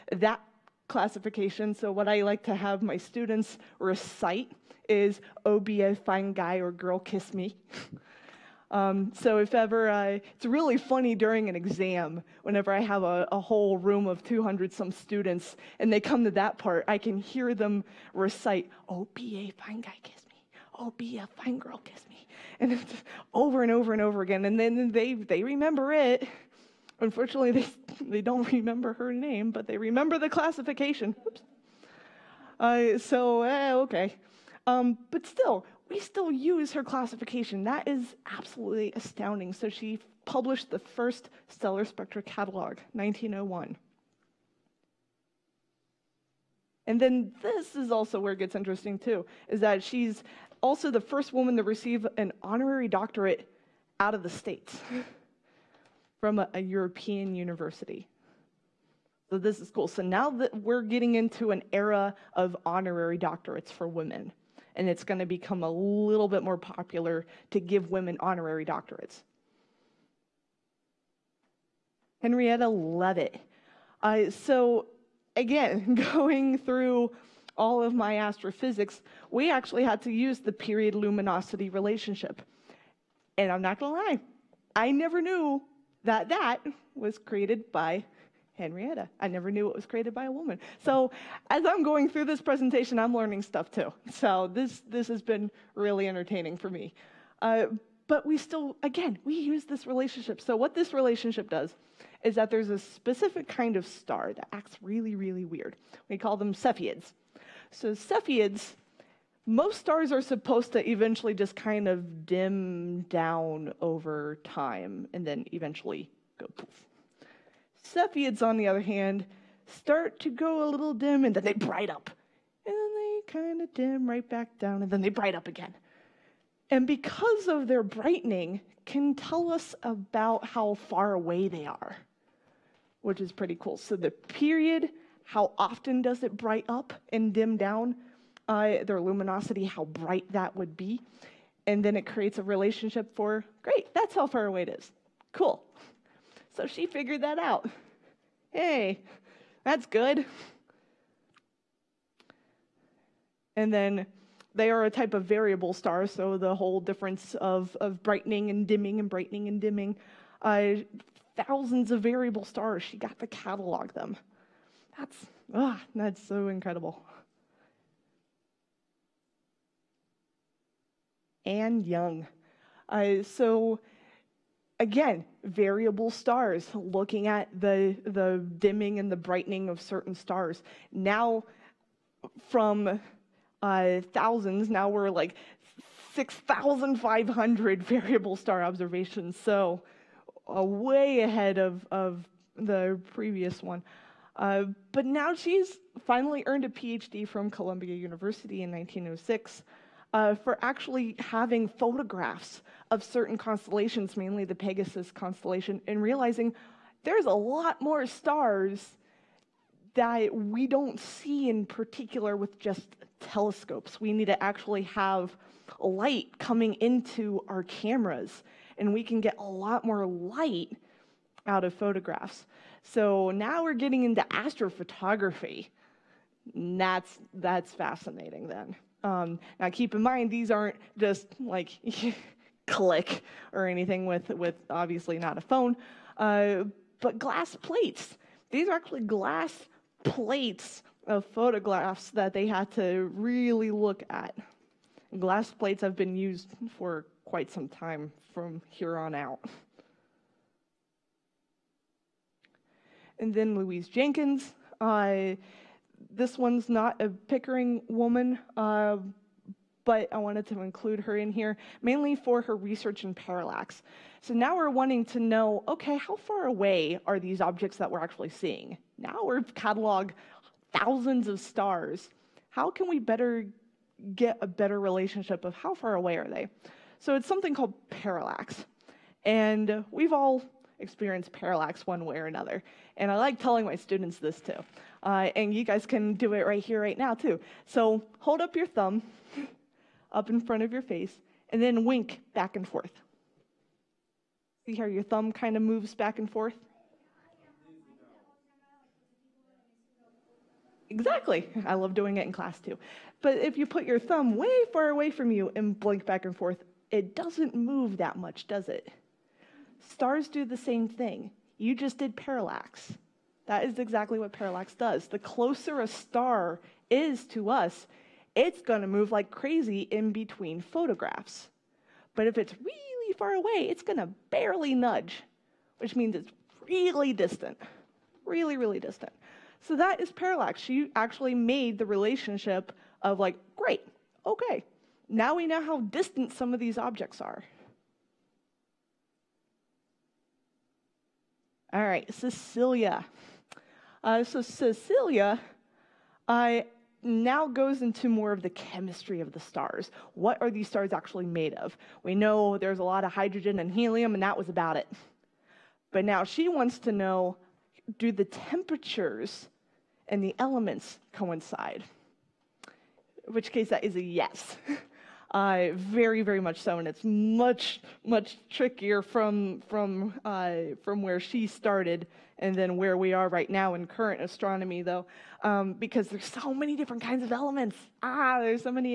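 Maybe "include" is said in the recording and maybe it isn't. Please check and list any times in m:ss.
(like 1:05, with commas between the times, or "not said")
4:20.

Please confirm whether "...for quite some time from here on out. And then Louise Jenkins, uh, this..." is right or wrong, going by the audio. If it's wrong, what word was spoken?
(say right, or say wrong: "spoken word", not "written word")
right.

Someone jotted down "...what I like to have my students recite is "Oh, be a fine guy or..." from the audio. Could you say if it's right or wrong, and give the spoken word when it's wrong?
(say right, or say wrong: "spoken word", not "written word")
right.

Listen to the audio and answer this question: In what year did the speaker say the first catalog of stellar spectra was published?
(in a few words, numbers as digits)
1901.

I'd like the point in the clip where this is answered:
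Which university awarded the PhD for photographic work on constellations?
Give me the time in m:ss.
3:17.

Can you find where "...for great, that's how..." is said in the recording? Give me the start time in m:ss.
2:23.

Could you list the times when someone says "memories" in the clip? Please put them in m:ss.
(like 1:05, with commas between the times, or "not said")
not said.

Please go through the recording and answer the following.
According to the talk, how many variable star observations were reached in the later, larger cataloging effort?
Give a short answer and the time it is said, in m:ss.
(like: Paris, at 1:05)
6,500, at 3:06.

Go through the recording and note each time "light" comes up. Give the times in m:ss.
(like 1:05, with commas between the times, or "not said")
3:35, 3:40.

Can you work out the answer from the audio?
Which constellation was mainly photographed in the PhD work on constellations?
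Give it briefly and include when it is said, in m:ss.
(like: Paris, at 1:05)
Pegasus, at 3:24.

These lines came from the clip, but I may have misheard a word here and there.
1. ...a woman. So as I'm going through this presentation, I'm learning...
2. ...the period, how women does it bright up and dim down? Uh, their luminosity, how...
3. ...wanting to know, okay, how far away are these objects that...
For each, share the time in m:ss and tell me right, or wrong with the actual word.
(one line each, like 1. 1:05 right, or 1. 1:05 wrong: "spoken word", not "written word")
1. 1:30 right
2. 2:13 wrong: "often", not "women"
3. 4:24 right.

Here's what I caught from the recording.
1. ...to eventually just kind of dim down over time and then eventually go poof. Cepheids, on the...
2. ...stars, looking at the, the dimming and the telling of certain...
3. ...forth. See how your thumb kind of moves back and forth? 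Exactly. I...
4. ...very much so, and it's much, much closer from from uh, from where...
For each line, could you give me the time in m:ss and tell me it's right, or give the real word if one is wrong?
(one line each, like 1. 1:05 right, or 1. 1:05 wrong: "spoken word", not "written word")
1. 1:50 right
2. 2:56 wrong: "brightening", not "telling"
3. 4:52 right
4. 6:06 wrong: "trickier", not "closer".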